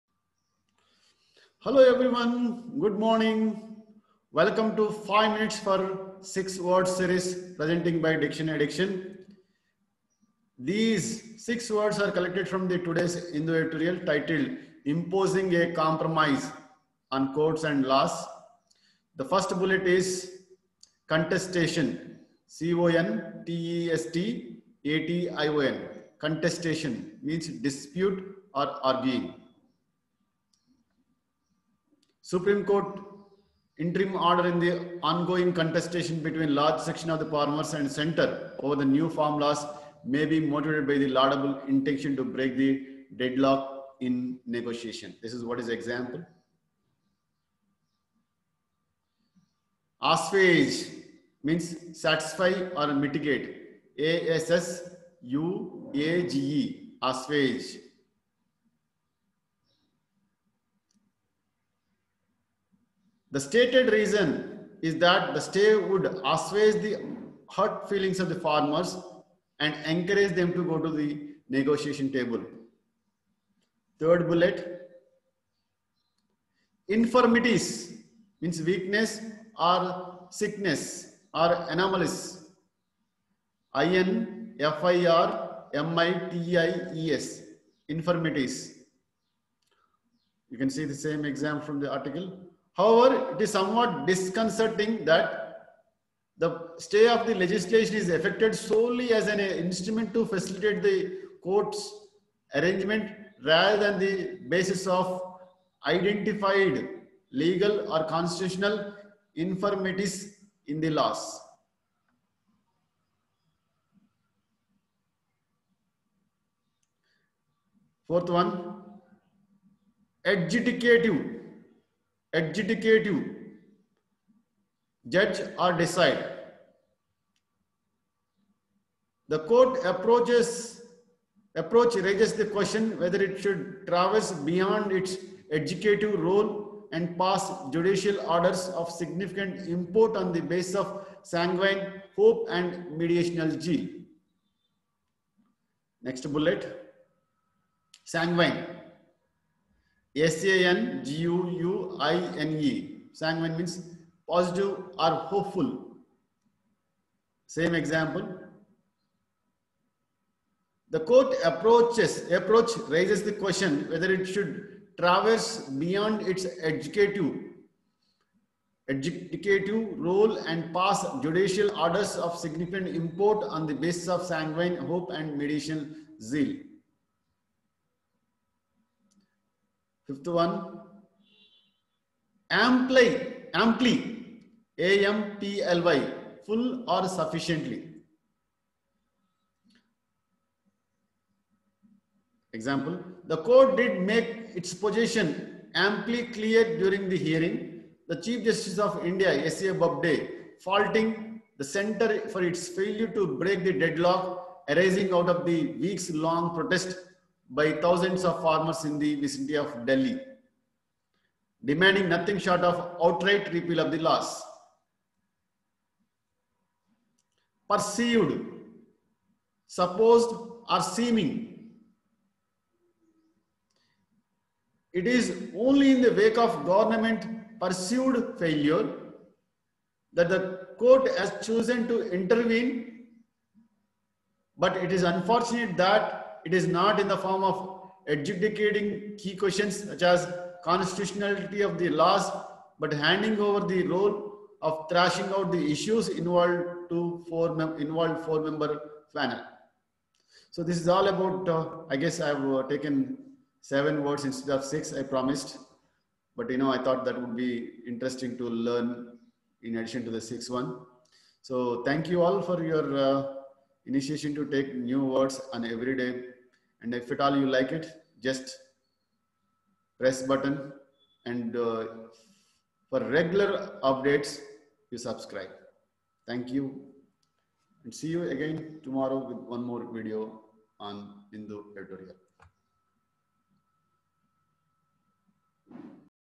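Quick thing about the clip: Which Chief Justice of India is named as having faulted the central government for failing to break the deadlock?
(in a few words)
S.A. Bobde.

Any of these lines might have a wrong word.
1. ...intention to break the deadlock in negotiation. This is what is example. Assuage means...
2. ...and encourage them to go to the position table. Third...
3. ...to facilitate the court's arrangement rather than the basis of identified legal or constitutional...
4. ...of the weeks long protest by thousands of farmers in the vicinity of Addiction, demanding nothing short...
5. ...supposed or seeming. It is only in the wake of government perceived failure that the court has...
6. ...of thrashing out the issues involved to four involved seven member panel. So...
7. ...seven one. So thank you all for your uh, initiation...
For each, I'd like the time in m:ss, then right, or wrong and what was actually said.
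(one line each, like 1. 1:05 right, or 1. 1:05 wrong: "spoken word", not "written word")
1. 0:41 right
2. 1:09 wrong: "negotiation", not "position"
3. 1:40 right
4. 3:25 wrong: "Delhi", not "Addiction"
5. 3:39 right
6. 4:04 wrong: "four", not "seven"
7. 4:20 wrong: "six", not "seven".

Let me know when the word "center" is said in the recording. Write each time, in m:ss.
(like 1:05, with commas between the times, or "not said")
0:37, 3:21.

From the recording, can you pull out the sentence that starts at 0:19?
The first bullet is contestation, C-O-N-T-E-S-T-A-T-I-O-N.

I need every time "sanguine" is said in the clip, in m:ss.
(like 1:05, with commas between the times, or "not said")
2:21, 2:28, 2:33, 2:54.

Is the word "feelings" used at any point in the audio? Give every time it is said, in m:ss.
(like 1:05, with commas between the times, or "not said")
1:07.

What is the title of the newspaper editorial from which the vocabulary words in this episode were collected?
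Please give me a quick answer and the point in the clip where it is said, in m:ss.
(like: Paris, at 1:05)
Imposing a Compromise on Courts and Laws, at 0:14.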